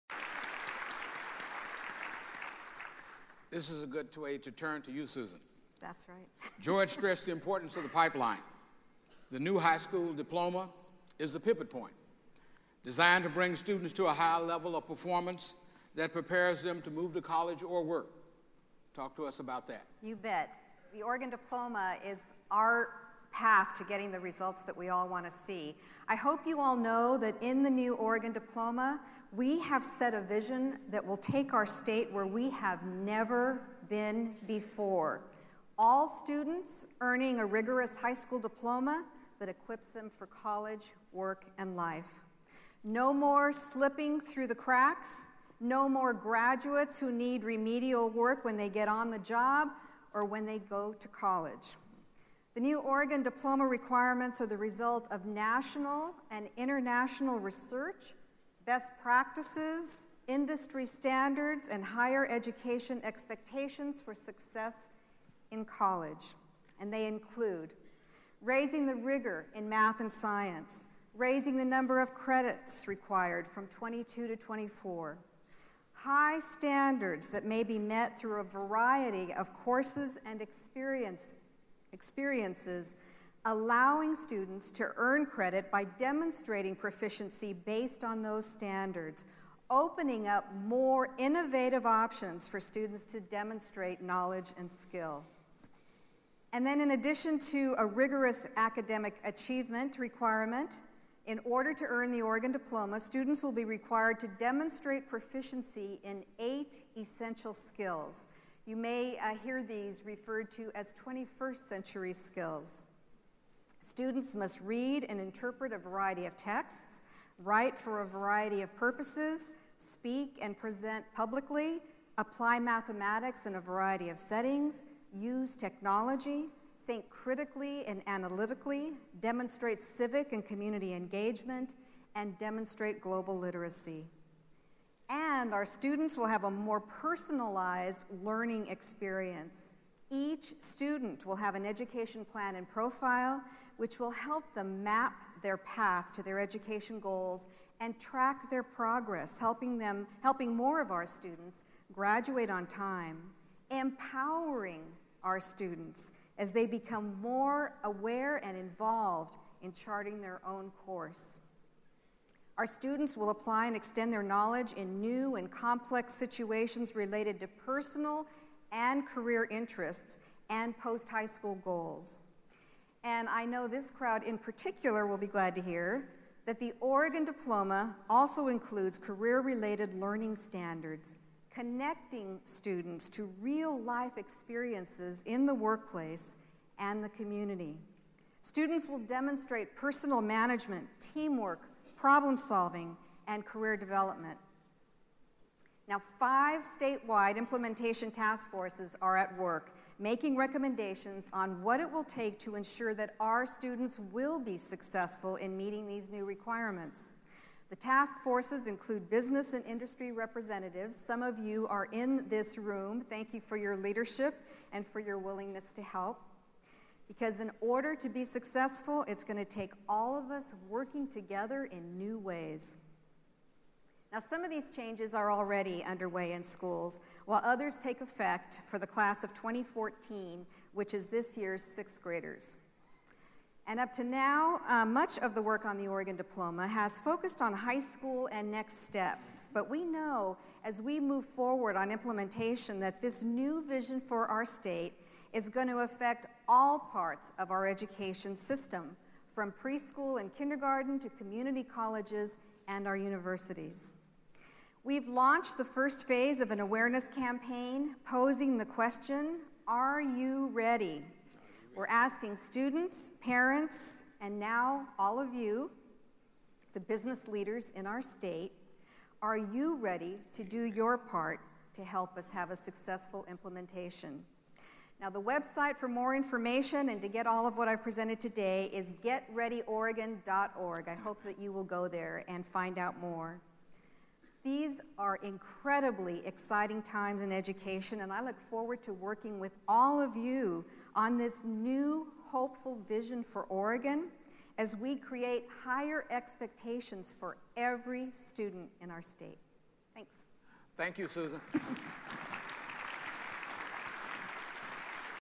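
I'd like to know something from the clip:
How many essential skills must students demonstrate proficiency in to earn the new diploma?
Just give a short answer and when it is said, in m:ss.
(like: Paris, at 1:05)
8, at 1:46.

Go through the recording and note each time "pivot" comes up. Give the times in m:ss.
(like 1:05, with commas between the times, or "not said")
0:11.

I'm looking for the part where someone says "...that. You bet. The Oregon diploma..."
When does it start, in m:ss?
0:19.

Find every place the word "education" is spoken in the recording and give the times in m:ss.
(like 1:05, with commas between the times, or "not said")
1:02, 2:21, 2:26, 4:07, 4:47.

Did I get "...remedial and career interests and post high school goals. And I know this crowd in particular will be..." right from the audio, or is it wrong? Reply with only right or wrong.
wrong.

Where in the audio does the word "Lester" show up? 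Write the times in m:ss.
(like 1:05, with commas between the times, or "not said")
not said.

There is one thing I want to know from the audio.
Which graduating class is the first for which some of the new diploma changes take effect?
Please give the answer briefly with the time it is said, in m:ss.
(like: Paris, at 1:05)
Class of 2014, at 3:48.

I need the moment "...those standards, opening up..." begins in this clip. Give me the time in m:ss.
1:28.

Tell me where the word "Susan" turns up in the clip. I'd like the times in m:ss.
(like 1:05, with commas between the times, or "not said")
0:05, 5:01.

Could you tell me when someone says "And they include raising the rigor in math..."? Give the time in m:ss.
1:06.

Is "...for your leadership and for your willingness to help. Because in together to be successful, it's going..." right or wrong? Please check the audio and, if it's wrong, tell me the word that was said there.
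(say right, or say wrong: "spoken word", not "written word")
wrong: "order", not "together".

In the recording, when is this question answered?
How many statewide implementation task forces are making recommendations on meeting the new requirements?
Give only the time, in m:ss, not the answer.
3:16.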